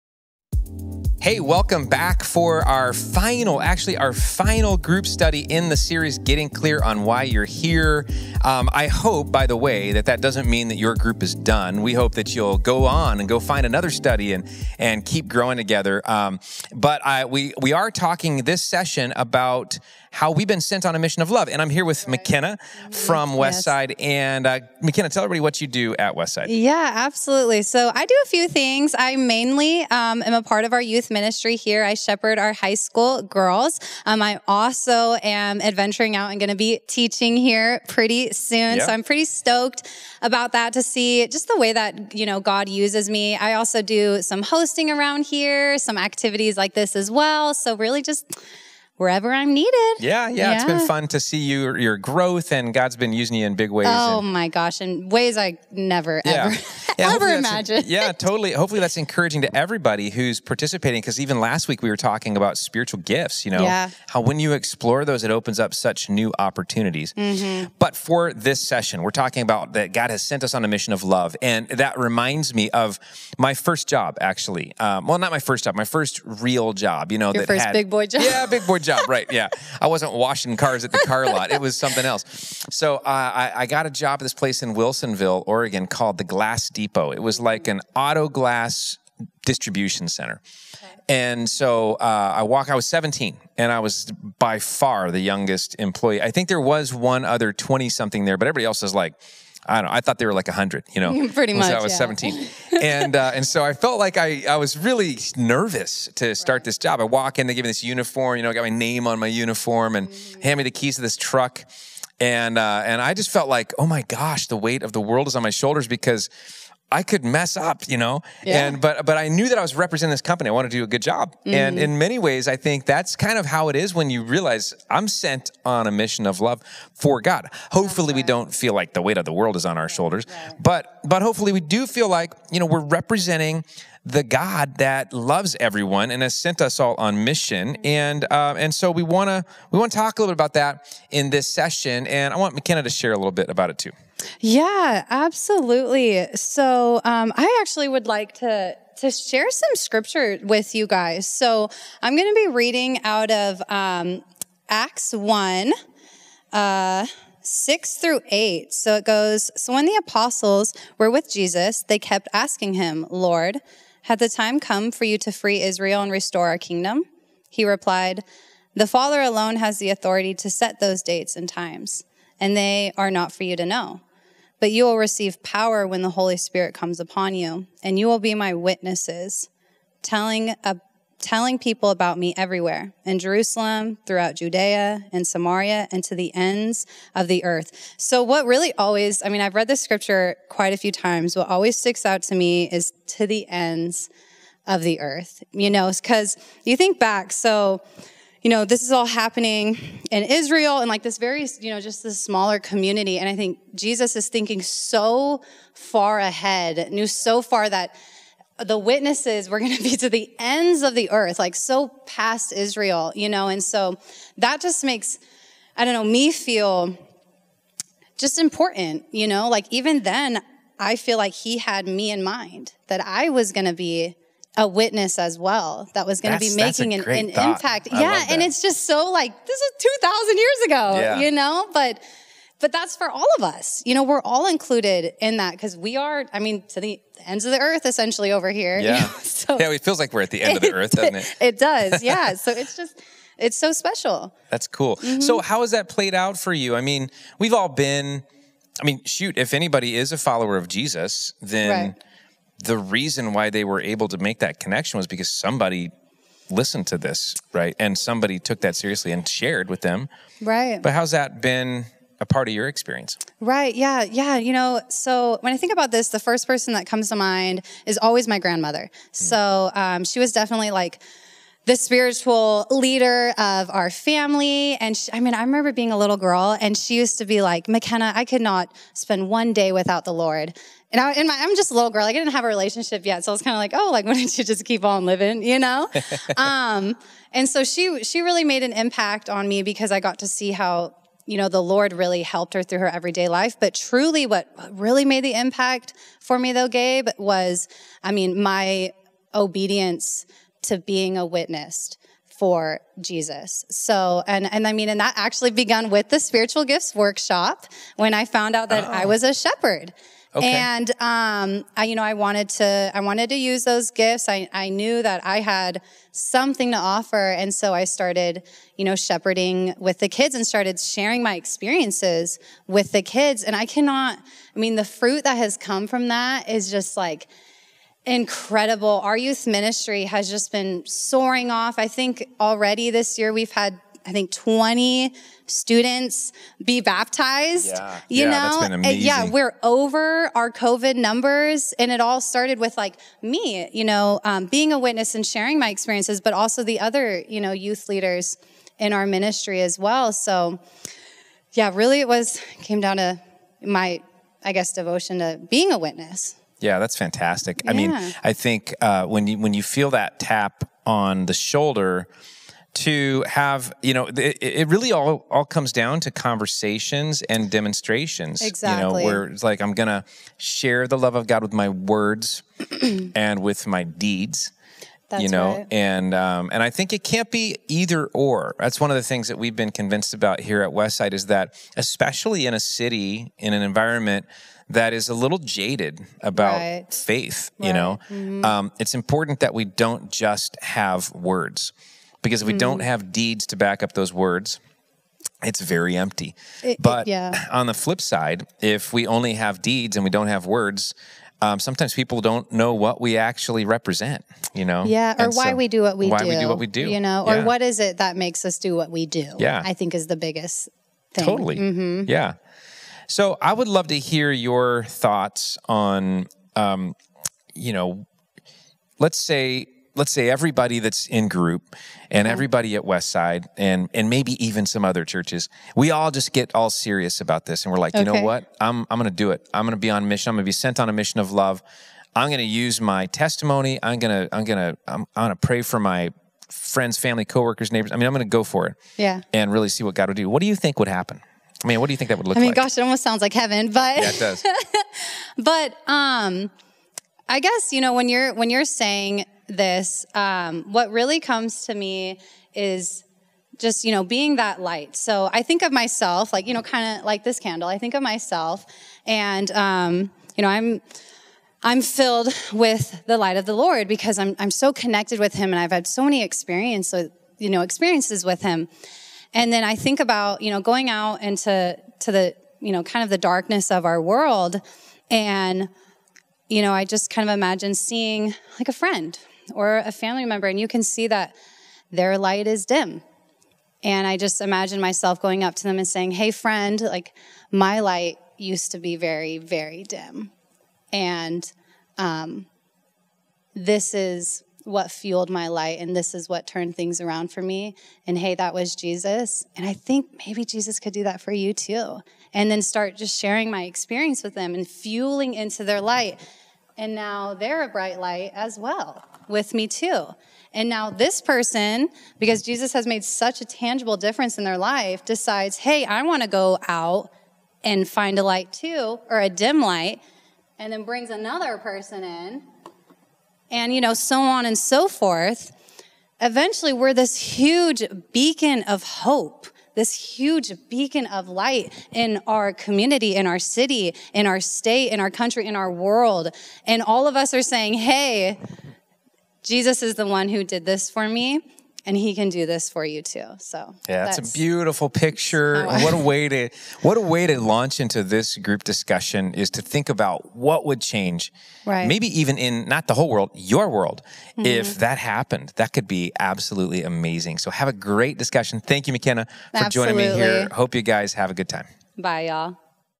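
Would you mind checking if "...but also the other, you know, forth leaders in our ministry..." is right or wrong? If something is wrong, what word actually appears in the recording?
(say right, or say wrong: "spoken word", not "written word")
wrong: "youth", not "forth".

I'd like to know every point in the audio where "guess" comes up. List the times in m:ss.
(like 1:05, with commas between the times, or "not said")
5:54, 7:27.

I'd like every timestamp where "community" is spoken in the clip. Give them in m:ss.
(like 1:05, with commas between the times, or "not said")
3:22, 8:52.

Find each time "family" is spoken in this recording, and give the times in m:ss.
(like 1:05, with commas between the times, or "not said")
4:33, 7:16, 7:59.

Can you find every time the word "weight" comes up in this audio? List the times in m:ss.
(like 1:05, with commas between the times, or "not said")
1:54, 2:09.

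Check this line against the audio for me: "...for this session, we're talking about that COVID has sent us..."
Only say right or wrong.
wrong.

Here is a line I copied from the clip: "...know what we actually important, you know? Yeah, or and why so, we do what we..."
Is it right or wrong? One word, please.
wrong.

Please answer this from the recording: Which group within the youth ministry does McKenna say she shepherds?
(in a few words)
High school girls.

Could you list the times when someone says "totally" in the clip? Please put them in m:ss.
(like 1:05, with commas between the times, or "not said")
0:58, 6:51.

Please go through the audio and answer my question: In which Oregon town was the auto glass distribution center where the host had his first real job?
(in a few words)
Wilsonville.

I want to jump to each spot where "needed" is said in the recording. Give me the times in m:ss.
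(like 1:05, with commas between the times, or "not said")
0:49.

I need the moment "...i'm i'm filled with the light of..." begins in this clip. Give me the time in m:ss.
7:40.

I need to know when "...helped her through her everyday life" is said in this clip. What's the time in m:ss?
4:52.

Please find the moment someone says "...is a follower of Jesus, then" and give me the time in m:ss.
4:09.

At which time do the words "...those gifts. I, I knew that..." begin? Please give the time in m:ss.
5:13.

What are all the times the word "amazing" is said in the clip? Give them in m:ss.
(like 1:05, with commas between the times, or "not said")
5:38, 9:16.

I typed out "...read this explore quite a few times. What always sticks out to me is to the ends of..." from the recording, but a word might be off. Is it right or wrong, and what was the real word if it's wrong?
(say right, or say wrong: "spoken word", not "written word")
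wrong: "scripture", not "explore".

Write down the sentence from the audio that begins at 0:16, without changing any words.
Um, but I, we, we are talking this session about how we've been sent on a mission of love.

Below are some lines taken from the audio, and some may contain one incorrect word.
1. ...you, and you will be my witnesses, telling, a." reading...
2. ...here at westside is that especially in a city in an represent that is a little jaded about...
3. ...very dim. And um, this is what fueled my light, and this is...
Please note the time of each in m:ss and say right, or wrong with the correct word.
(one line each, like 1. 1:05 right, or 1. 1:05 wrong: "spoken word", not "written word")
1. 2:57 wrong: "telling", not "reading"
2. 6:20 wrong: "environment", not "represent"
3. 8:09 right.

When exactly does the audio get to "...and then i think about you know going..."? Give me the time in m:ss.
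7:49.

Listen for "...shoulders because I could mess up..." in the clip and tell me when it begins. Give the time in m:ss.
1:55.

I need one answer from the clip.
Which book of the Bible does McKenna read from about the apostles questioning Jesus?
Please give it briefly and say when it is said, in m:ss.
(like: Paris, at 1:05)
Acts, at 2:34.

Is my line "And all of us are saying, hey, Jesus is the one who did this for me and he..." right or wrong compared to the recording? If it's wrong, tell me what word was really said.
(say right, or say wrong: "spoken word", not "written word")
right.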